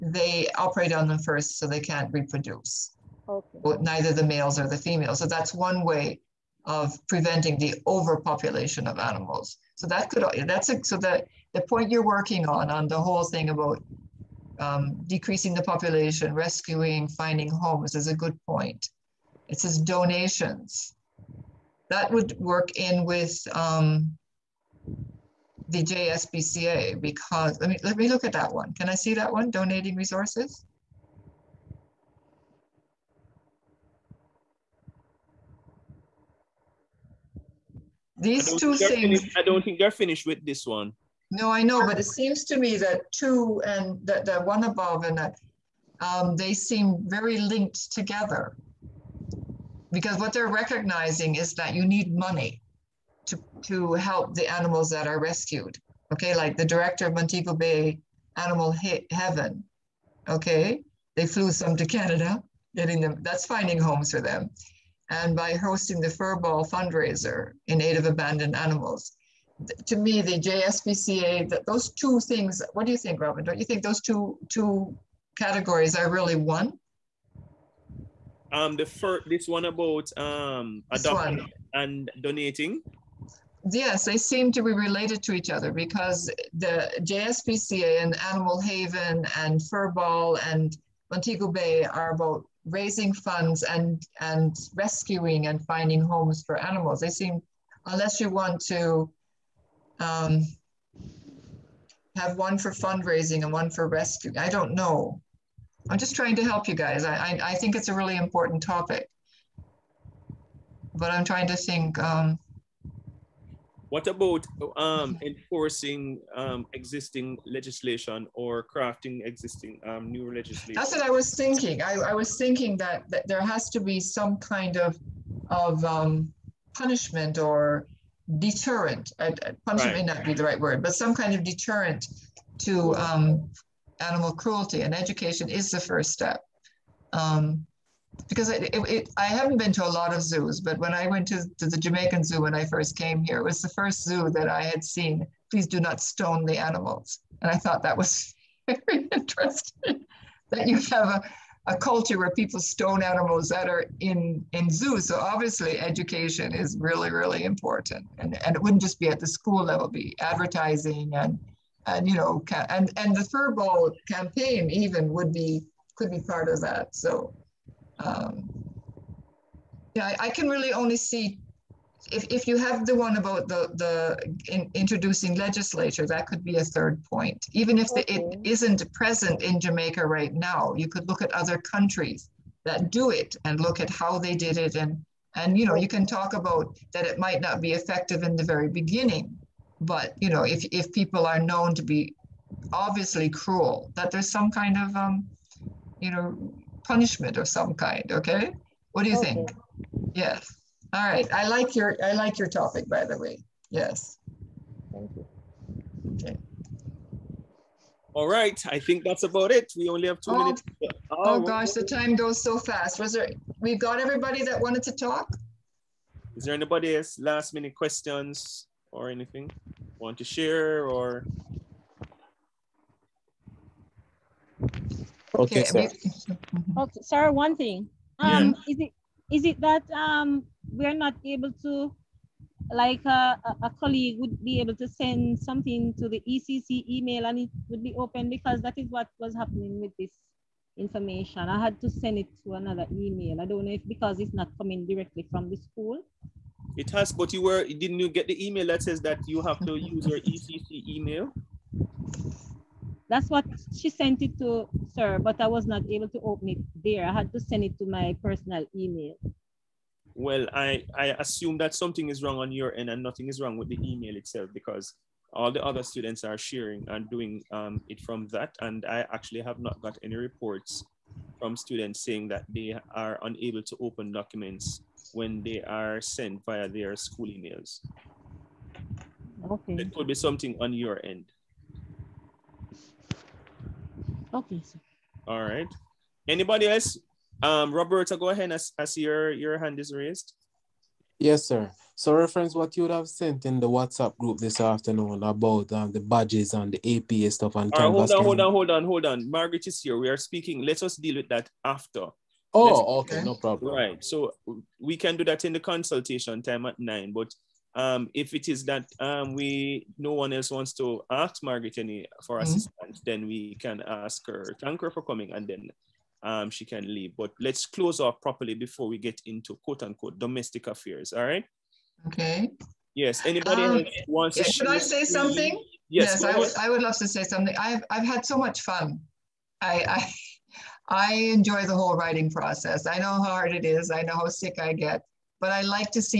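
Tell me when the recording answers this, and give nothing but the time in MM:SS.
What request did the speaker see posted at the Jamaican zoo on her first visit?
02:25.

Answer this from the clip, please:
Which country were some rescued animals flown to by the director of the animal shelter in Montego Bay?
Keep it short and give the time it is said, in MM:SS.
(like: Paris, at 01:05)
Canada, at 01:01.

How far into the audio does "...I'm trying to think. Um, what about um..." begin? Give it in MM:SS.
01:51.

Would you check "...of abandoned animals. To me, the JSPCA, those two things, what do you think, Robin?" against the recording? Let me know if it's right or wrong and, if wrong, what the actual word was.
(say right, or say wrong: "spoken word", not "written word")
right.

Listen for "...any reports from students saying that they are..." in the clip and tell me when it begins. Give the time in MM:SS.
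04:30.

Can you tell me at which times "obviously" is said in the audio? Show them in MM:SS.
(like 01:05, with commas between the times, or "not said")
02:35, 03:12.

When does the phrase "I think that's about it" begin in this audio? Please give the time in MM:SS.
03:28.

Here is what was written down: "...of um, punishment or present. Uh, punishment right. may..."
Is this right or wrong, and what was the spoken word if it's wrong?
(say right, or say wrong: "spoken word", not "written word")
wrong: "deterrent", not "present".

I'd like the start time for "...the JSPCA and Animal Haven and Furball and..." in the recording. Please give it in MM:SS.
01:26.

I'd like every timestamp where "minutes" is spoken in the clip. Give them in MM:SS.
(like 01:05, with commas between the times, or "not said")
03:30, 03:37.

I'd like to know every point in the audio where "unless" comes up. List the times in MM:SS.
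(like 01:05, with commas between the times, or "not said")
01:37.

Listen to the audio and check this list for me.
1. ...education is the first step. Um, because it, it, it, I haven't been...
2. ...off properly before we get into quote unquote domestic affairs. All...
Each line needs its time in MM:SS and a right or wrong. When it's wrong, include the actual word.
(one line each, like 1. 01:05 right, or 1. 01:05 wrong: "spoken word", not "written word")
1. 02:14 right
2. 05:18 right.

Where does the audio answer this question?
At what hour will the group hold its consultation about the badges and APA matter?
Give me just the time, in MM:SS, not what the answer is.
05:06.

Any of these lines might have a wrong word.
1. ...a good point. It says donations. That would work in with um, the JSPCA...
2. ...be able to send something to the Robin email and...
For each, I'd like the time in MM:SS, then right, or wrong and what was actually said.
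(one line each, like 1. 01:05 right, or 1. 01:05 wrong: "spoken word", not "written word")
1. 00:18 right
2. 03:54 wrong: "ECC", not "Robin".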